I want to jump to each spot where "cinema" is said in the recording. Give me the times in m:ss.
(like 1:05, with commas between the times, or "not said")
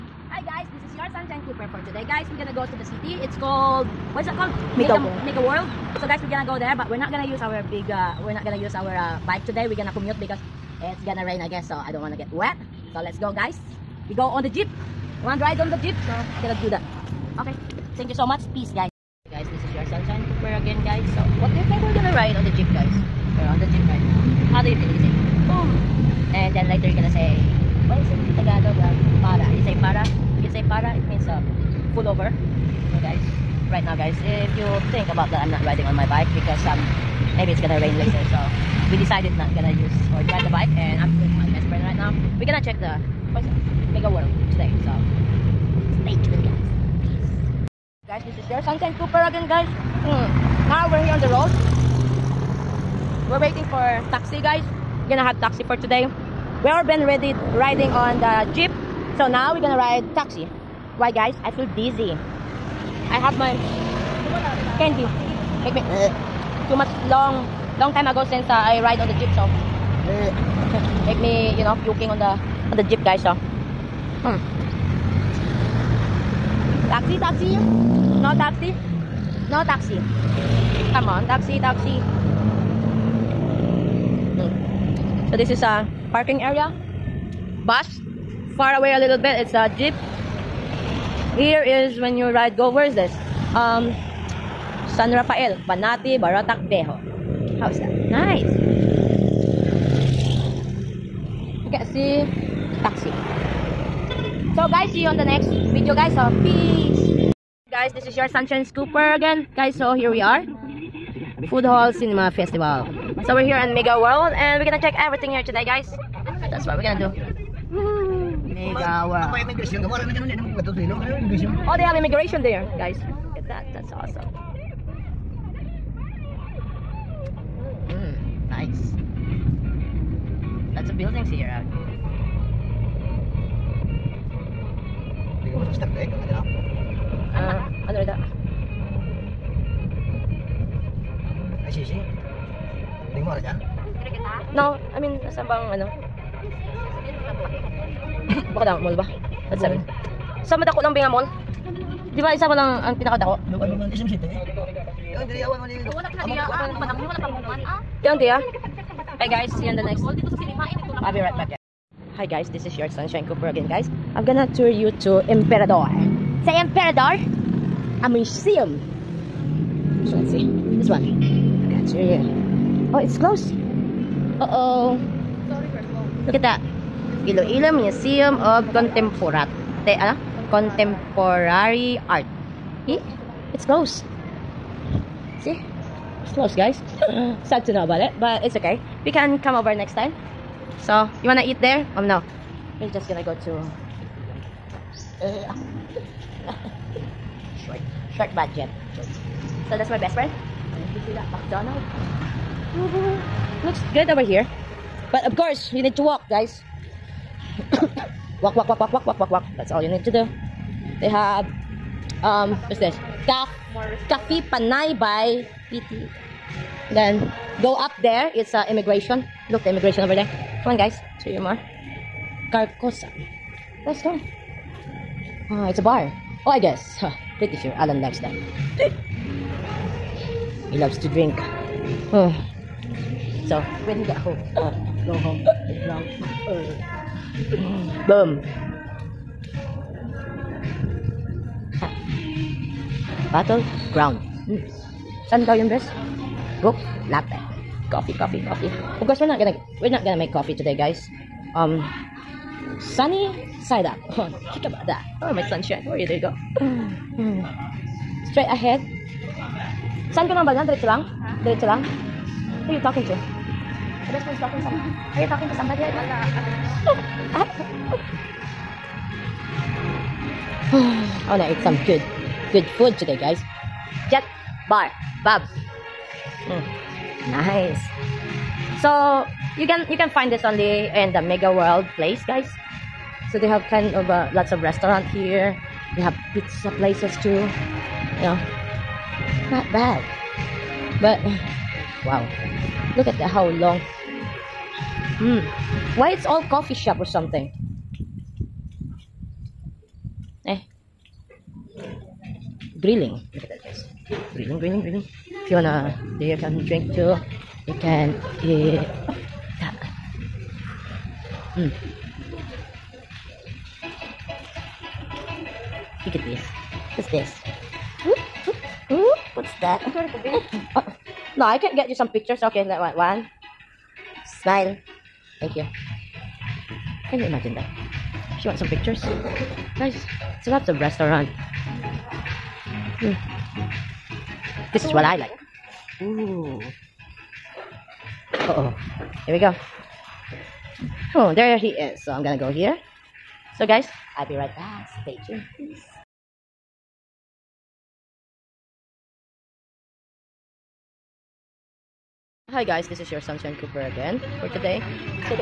1:51, 2:40.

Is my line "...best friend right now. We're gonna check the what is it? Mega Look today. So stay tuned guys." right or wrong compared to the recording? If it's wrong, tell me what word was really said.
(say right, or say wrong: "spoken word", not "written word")
wrong: "World", not "Look".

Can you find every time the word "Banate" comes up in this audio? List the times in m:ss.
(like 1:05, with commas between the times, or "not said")
1:35.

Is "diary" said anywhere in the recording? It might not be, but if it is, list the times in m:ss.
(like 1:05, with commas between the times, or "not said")
not said.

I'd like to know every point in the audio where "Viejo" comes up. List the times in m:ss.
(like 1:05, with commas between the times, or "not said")
1:36.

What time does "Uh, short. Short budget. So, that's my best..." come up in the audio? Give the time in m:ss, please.
3:15.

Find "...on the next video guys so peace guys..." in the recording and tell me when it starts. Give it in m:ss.
1:45.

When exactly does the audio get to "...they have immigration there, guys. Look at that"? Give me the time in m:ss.
2:01.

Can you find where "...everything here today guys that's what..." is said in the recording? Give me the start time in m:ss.
1:54.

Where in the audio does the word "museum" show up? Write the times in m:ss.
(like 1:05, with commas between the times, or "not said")
2:48, 2:57.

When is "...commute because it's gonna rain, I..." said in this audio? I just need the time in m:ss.
0:09.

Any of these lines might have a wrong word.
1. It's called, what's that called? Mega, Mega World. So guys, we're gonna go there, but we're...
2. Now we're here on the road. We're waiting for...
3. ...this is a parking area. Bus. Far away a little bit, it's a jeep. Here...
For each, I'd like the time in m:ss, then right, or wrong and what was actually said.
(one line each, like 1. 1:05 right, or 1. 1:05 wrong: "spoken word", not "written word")
1. 0:03 right
2. 0:50 right
3. 1:25 right.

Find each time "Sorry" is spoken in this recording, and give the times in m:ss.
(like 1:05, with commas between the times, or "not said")
2:55.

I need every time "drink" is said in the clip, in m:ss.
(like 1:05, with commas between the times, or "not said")
3:51, 5:06.